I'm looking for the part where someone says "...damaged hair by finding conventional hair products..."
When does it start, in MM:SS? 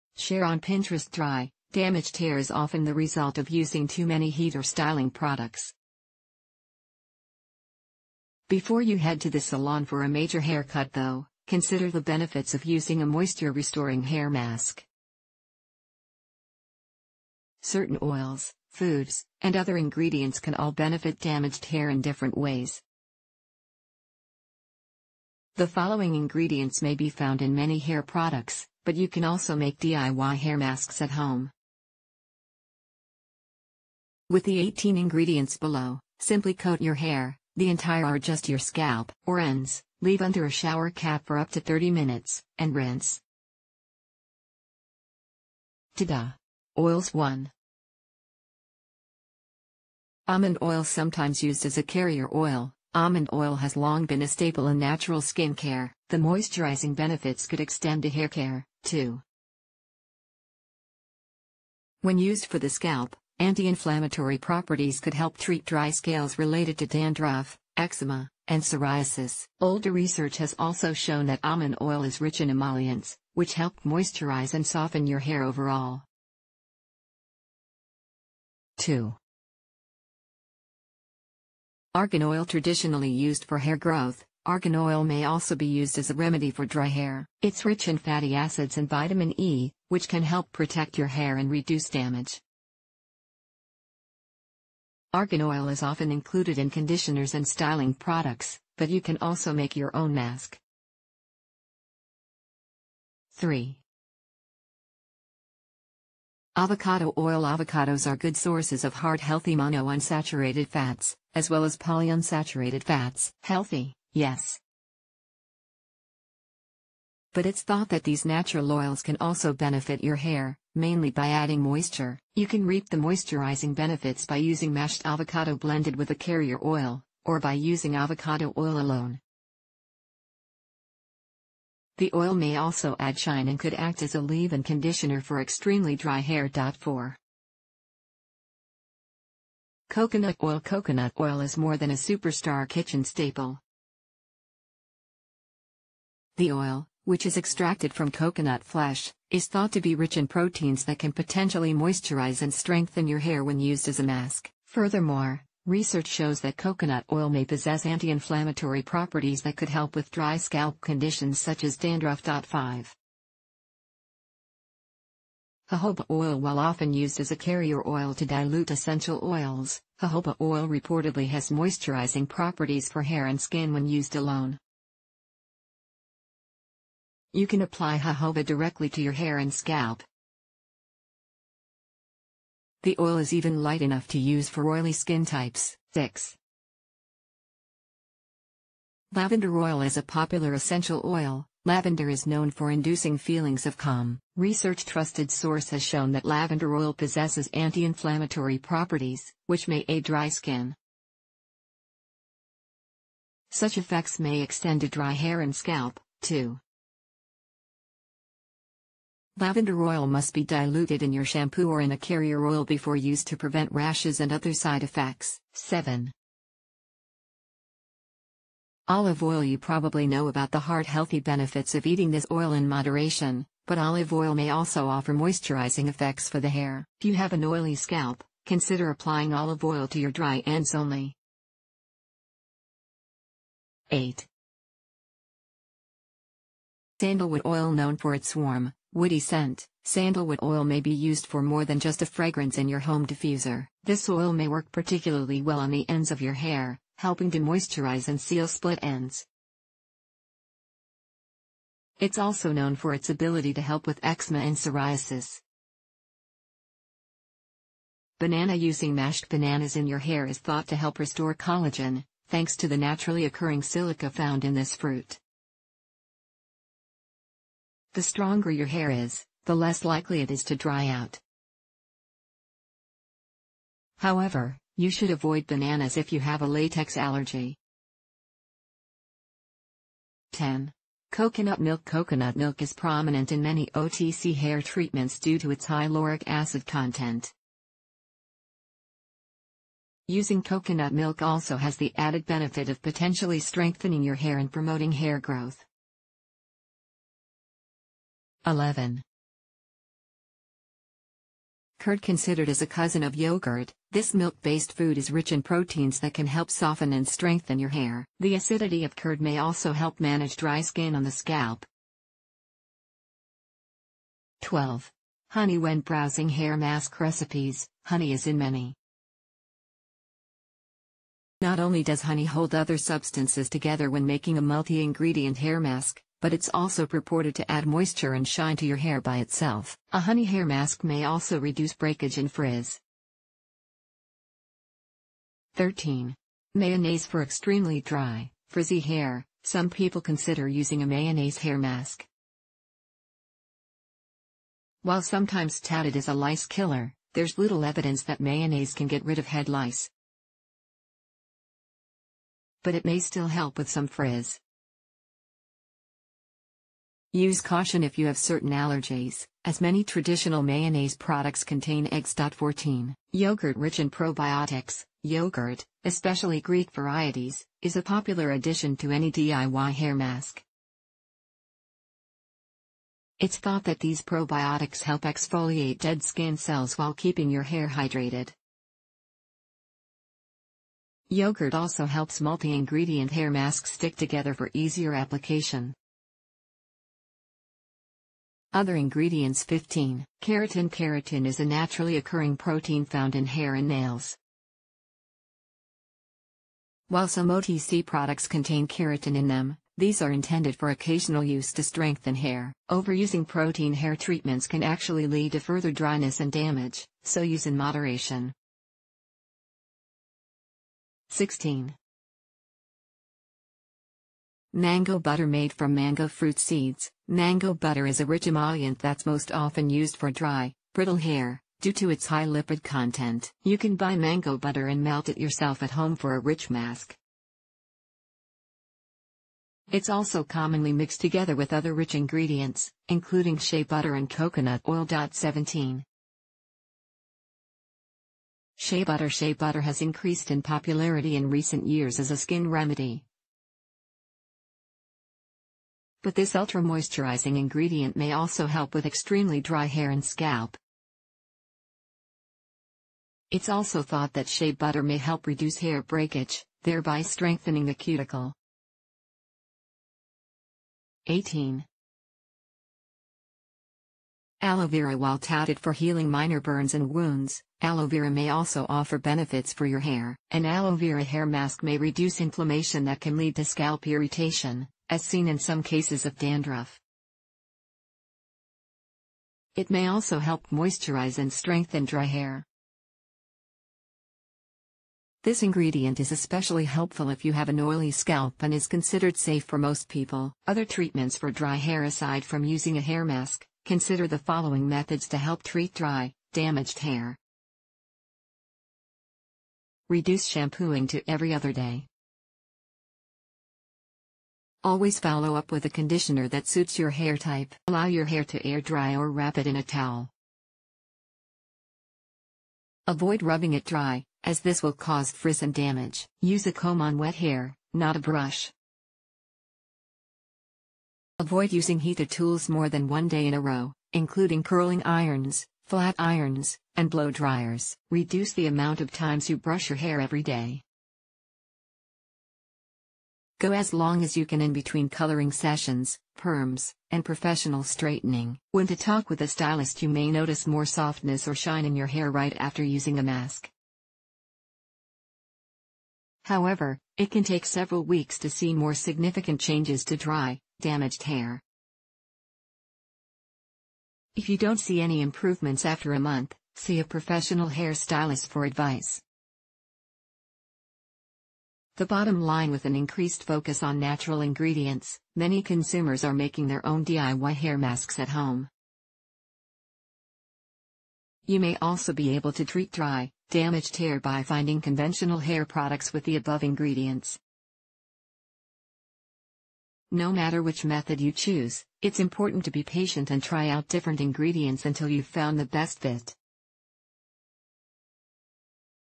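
09:33.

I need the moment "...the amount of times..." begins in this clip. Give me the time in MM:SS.
08:48.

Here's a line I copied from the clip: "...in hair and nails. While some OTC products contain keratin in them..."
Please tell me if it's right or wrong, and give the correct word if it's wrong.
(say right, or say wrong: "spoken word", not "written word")
right.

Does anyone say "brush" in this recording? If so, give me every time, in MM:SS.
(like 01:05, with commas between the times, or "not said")
08:37, 08:49.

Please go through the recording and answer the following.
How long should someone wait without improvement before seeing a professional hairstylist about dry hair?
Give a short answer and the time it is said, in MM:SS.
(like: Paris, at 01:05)
a month, at 09:15.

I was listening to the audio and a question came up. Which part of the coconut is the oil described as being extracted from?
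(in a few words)
coconut flesh.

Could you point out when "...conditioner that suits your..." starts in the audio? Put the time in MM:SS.
08:25.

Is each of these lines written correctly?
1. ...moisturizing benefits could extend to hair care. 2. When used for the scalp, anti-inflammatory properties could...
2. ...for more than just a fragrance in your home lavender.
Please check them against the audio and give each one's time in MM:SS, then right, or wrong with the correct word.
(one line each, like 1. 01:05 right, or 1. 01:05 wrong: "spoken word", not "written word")
1. 00:56 right
2. 04:01 wrong: "diffuser", not "lavender".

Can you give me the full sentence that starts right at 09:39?
No matter which method you choose, it's important to be patient and try out different ingredients until you've found the best fit.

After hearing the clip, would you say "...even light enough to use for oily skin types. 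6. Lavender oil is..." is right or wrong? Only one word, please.
right.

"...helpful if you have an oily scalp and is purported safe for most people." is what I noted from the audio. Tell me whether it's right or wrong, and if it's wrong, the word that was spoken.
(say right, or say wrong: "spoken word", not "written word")
wrong: "considered", not "purported".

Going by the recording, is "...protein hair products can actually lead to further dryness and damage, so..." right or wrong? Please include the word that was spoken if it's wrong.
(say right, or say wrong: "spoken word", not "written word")
wrong: "treatments", not "products".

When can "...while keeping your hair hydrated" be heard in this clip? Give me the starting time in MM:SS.
06:16.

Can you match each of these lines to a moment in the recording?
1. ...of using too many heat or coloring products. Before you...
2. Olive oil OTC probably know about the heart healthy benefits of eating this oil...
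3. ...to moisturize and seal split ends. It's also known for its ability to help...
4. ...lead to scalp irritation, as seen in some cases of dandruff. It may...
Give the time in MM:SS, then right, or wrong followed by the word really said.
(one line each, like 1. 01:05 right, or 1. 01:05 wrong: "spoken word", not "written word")
1. 00:03 wrong: "styling", not "coloring"
2. 03:38 wrong: "You", not "OTC"
3. 04:07 right
4. 07:53 right.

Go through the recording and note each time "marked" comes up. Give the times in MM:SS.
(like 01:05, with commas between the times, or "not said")
not said.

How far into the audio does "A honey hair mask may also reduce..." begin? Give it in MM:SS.
05:29.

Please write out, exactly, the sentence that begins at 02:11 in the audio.
The oil may also add shine and could act as a leave-in conditioner for extremely dry hair.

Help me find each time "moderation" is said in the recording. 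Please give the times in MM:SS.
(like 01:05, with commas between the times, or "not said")
03:42, 06:47.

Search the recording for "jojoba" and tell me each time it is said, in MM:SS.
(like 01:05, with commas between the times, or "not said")
02:45, 02:49, 02:57.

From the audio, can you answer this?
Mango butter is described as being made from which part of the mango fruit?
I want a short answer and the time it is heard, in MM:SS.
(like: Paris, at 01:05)
seeds, at 06:56.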